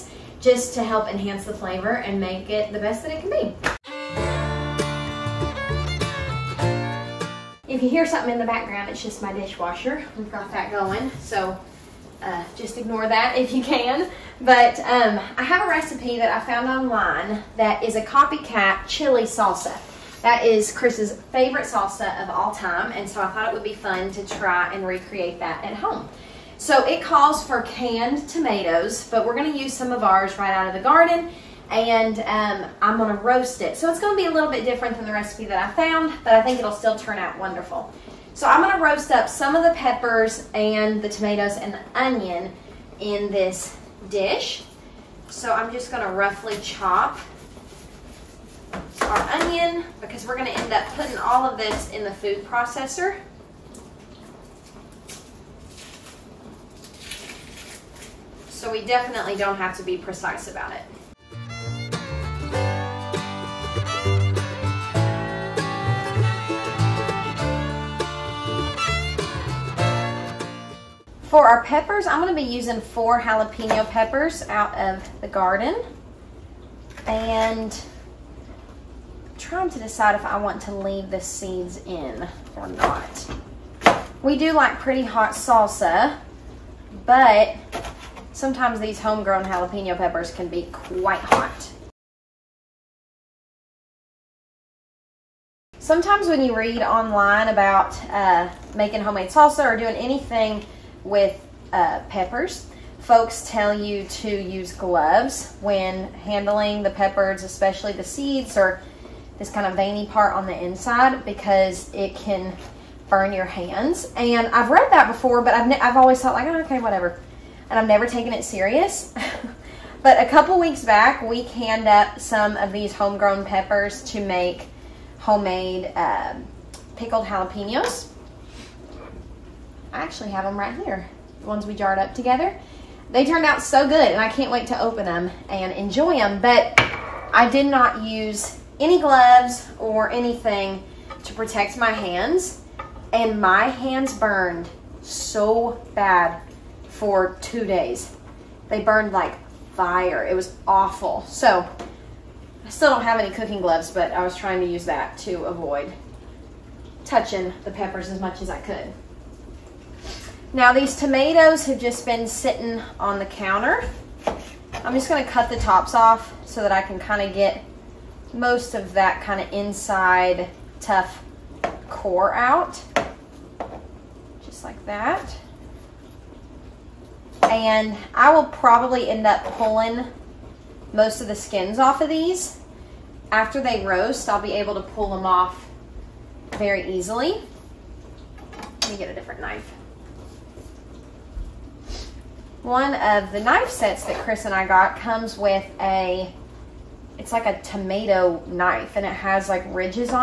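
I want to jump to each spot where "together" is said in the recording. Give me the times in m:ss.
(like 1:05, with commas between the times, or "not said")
2:12.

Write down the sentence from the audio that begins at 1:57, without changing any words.
And I've never taken it serious.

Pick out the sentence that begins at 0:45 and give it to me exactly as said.
So I'm just gonna roughly chop our onion because we're gonna end up putting all of this in the food processor.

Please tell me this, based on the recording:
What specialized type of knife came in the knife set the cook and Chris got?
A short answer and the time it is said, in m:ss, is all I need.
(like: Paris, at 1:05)
Tomato knife, at 3:17.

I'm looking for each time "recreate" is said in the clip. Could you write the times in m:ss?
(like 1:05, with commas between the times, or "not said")
0:24.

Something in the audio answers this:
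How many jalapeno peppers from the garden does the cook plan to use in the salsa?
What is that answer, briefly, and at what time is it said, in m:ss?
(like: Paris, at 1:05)
4, at 1:12.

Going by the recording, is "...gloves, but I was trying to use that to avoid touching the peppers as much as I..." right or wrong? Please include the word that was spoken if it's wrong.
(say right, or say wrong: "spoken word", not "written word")
right.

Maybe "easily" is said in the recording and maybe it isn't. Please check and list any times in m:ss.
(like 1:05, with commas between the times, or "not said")
3:06.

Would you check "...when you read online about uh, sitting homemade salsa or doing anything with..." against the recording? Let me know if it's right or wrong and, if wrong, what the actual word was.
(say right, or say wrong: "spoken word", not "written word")
wrong: "making", not "sitting".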